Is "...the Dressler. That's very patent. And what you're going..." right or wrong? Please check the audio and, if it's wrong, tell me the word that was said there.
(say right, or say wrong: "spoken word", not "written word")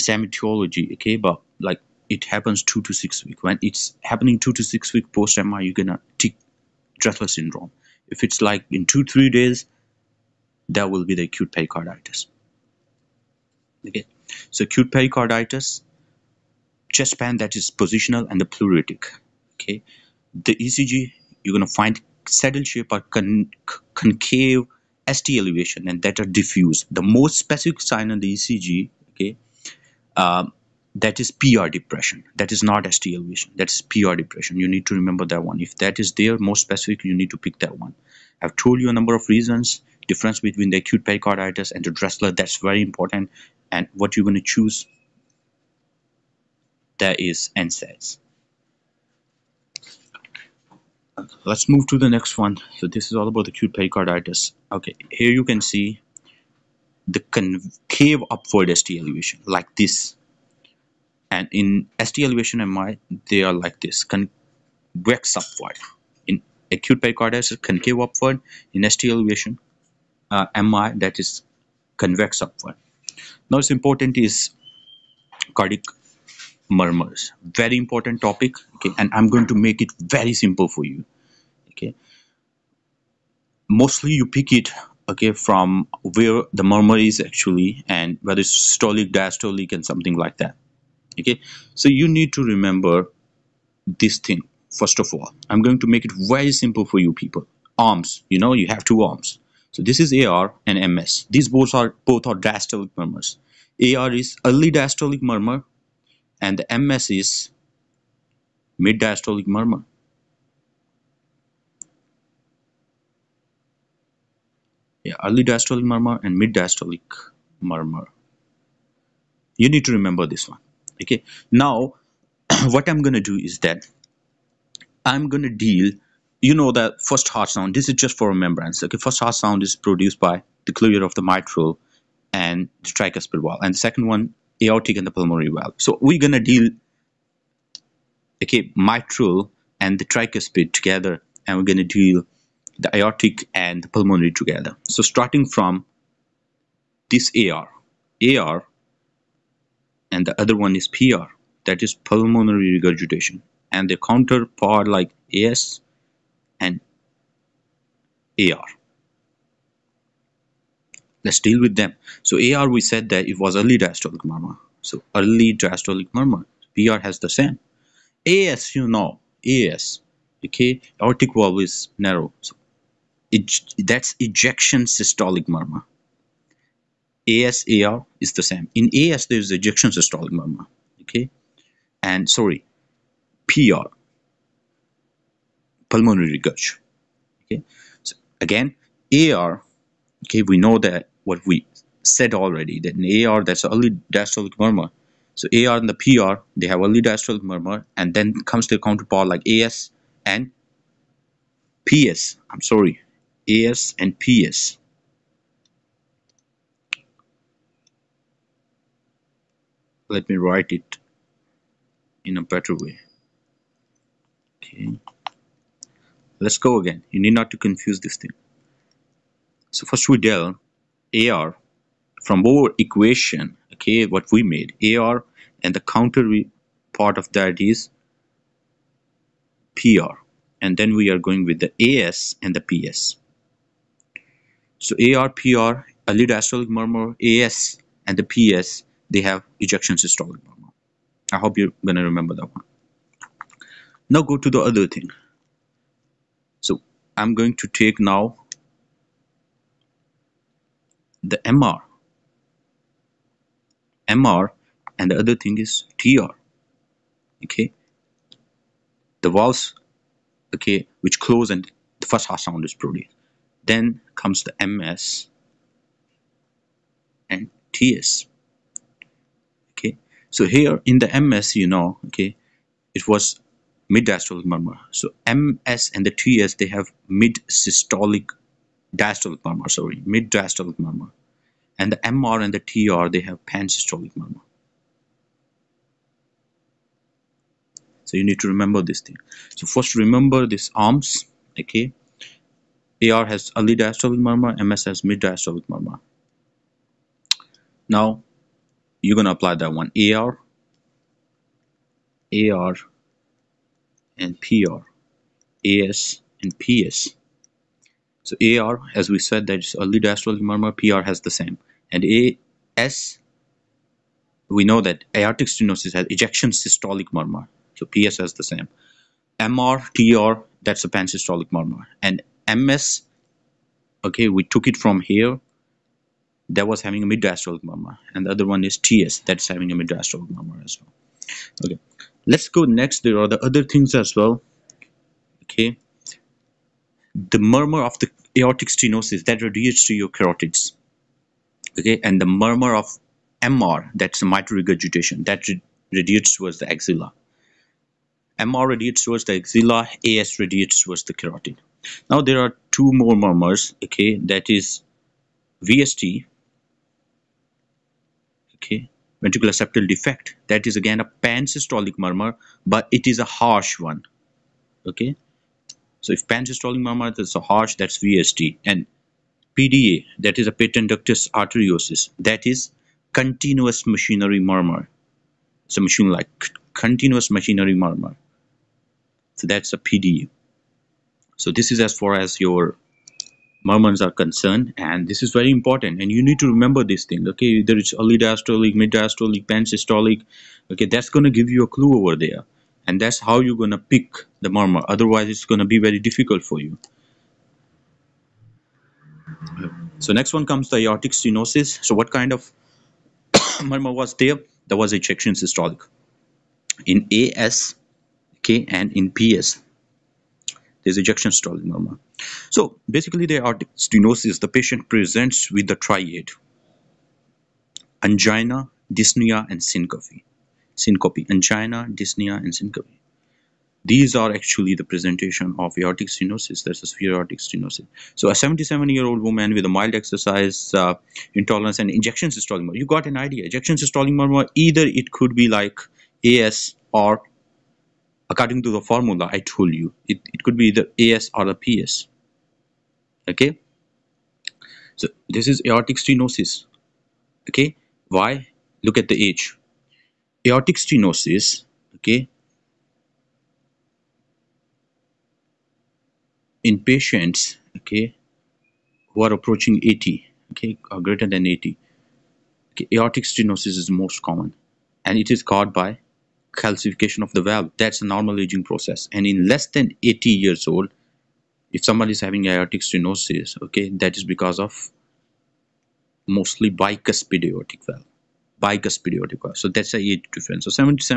wrong: "important", not "patent".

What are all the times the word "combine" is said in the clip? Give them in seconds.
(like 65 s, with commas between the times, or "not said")
not said.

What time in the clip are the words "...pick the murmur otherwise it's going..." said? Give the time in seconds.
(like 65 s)
393 s.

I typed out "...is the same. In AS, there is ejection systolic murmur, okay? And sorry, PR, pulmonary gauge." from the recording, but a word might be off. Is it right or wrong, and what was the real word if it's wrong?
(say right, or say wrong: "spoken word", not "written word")
right.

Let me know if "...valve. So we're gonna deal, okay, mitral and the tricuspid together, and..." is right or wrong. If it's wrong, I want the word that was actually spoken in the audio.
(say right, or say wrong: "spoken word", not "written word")
right.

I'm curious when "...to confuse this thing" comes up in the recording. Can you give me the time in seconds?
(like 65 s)
217 s.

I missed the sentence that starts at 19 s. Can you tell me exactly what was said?
Okay, the ECG you're gonna find saddle shape or con concave ST elevation and that are diffuse.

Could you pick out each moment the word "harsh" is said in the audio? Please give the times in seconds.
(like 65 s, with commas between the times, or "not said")
363 s, 367 s.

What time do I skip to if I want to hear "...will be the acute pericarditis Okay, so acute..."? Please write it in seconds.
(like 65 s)
10 s.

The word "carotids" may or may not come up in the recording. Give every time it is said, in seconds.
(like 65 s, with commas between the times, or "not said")
340 s, 351 s.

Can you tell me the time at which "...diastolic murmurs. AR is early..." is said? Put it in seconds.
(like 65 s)
102 s.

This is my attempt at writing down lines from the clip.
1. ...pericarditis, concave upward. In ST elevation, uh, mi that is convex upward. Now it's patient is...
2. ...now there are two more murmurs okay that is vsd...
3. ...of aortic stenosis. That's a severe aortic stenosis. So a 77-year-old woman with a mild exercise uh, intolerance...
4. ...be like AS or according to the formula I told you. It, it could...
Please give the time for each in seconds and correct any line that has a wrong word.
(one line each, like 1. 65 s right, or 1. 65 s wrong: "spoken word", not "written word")
1. 67 s wrong: "important", not "patient"
2. 352 s right
3. 425 s right
4. 435 s right.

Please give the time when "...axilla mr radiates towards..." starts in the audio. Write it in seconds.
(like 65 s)
346 s.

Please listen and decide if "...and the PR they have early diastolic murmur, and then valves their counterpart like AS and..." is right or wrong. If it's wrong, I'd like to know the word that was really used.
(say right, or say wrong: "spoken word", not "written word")
wrong: "comes", not "valves".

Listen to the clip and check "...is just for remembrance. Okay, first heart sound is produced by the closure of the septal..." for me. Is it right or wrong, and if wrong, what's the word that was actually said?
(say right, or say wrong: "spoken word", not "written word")
wrong: "mitral", not "septal".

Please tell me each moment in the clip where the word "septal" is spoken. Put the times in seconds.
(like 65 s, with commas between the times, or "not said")
359 s.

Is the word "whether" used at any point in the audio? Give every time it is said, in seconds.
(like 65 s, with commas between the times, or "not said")
88 s, 387 s.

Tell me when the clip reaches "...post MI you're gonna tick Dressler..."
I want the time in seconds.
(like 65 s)
5 s.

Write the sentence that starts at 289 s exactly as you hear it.
So first remember these arms, okay?